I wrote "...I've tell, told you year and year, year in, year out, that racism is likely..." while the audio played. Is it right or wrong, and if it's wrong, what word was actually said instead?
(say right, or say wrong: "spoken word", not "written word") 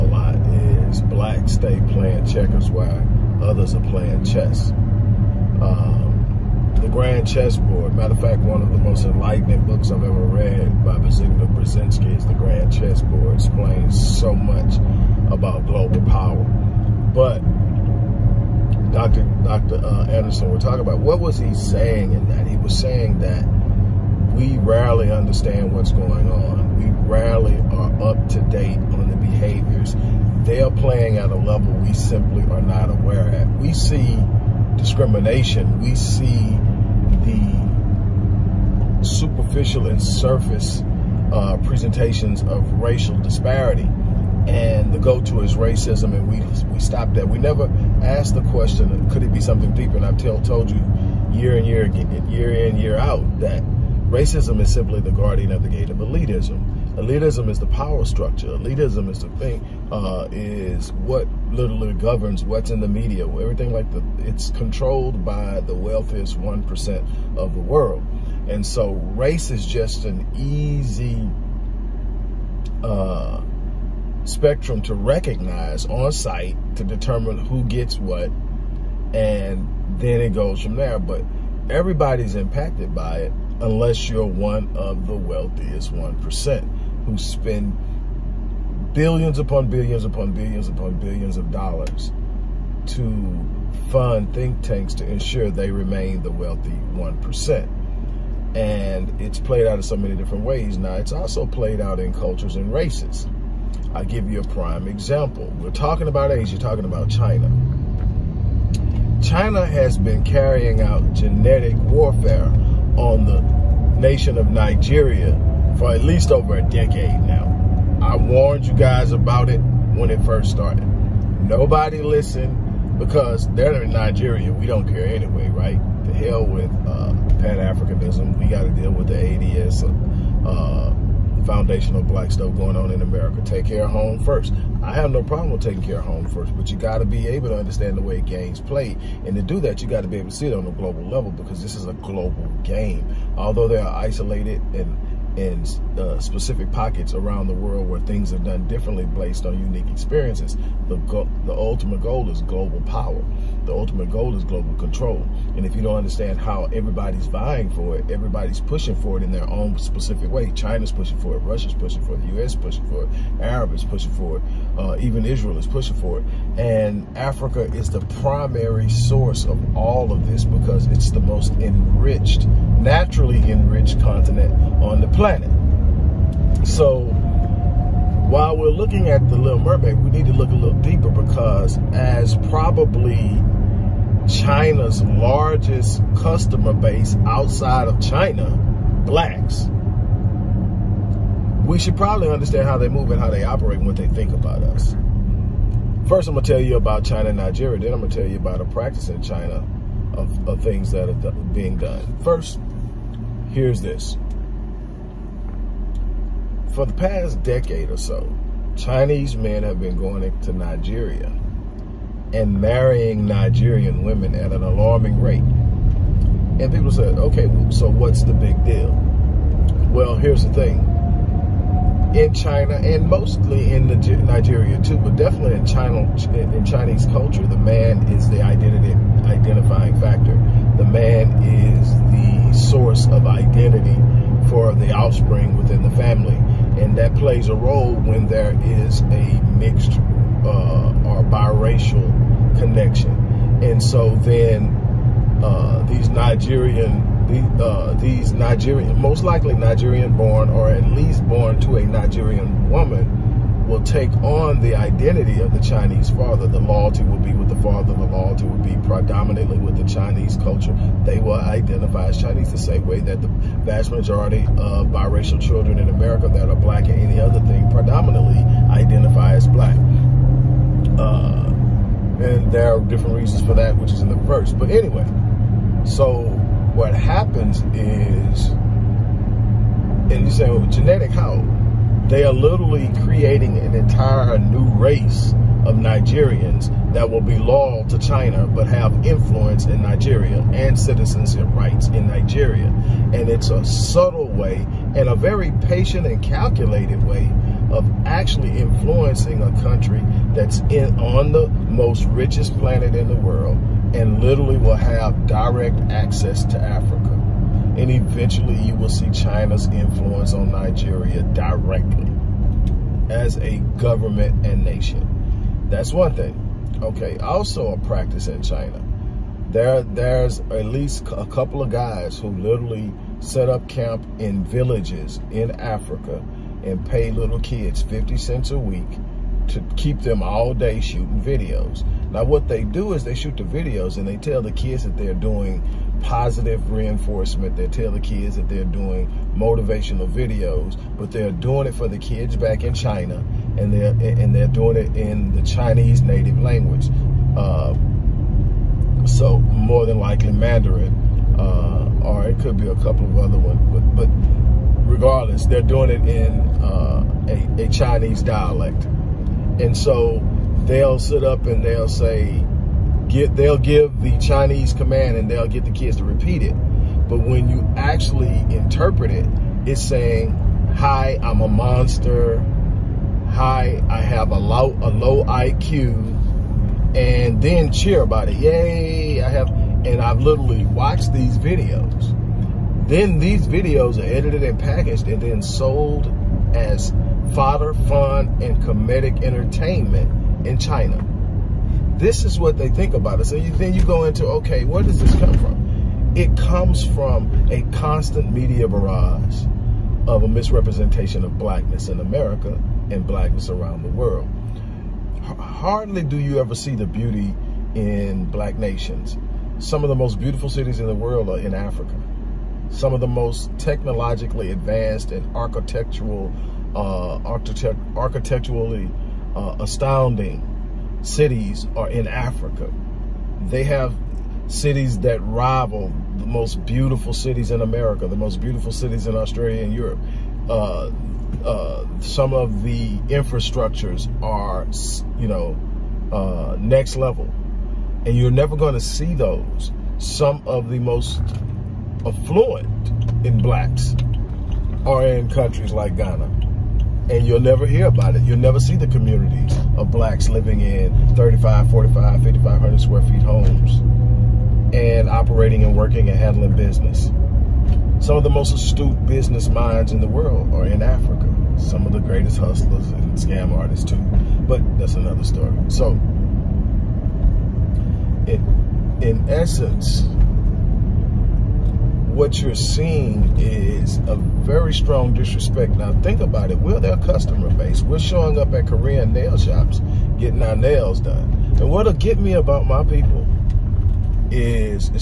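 wrong: "simply", not "likely".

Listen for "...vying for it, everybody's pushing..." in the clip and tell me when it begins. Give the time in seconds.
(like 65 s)
157 s.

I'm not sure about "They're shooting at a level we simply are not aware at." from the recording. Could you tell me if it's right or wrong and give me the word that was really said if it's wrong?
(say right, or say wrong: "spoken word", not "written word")
wrong: "playing", not "shooting".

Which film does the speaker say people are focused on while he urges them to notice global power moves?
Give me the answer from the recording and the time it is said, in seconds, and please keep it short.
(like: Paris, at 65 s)
The Little Mermaid, at 179 s.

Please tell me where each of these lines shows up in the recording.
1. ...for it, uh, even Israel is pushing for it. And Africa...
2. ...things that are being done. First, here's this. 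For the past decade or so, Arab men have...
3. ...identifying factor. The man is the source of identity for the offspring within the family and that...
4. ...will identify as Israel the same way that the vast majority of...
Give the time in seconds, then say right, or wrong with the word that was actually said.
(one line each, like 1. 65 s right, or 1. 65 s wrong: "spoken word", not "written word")
1. 164 s right
2. 200 s wrong: "Chinese", not "Arab"
3. 229 s right
4. 261 s wrong: "Chinese", not "Israel".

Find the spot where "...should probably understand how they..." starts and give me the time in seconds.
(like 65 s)
191 s.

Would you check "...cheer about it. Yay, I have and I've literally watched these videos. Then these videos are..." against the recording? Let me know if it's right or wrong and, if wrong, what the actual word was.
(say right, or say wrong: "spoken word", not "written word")
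right.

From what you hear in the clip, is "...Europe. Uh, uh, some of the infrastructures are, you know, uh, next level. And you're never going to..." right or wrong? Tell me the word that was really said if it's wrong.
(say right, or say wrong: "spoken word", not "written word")
right.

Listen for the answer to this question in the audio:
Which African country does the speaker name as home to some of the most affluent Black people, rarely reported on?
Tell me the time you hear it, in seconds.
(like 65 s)
445 s.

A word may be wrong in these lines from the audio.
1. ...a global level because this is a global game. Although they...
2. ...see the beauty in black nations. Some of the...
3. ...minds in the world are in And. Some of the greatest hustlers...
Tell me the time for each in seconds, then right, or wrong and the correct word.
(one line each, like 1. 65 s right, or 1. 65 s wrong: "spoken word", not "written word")
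1. 140 s right
2. 406 s right
3. 459 s wrong: "Africa", not "And".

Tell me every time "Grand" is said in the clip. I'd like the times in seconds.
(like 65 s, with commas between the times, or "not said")
6 s, 12 s.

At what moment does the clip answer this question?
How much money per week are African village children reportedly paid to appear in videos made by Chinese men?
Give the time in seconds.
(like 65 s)
327 s.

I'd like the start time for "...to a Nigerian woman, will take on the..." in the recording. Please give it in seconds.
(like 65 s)
251 s.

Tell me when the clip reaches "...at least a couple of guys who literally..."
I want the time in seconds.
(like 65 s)
320 s.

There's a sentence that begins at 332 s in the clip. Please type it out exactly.
Now what they do is they shoot the videos and they tell the kids that they're doing positive reinforcement.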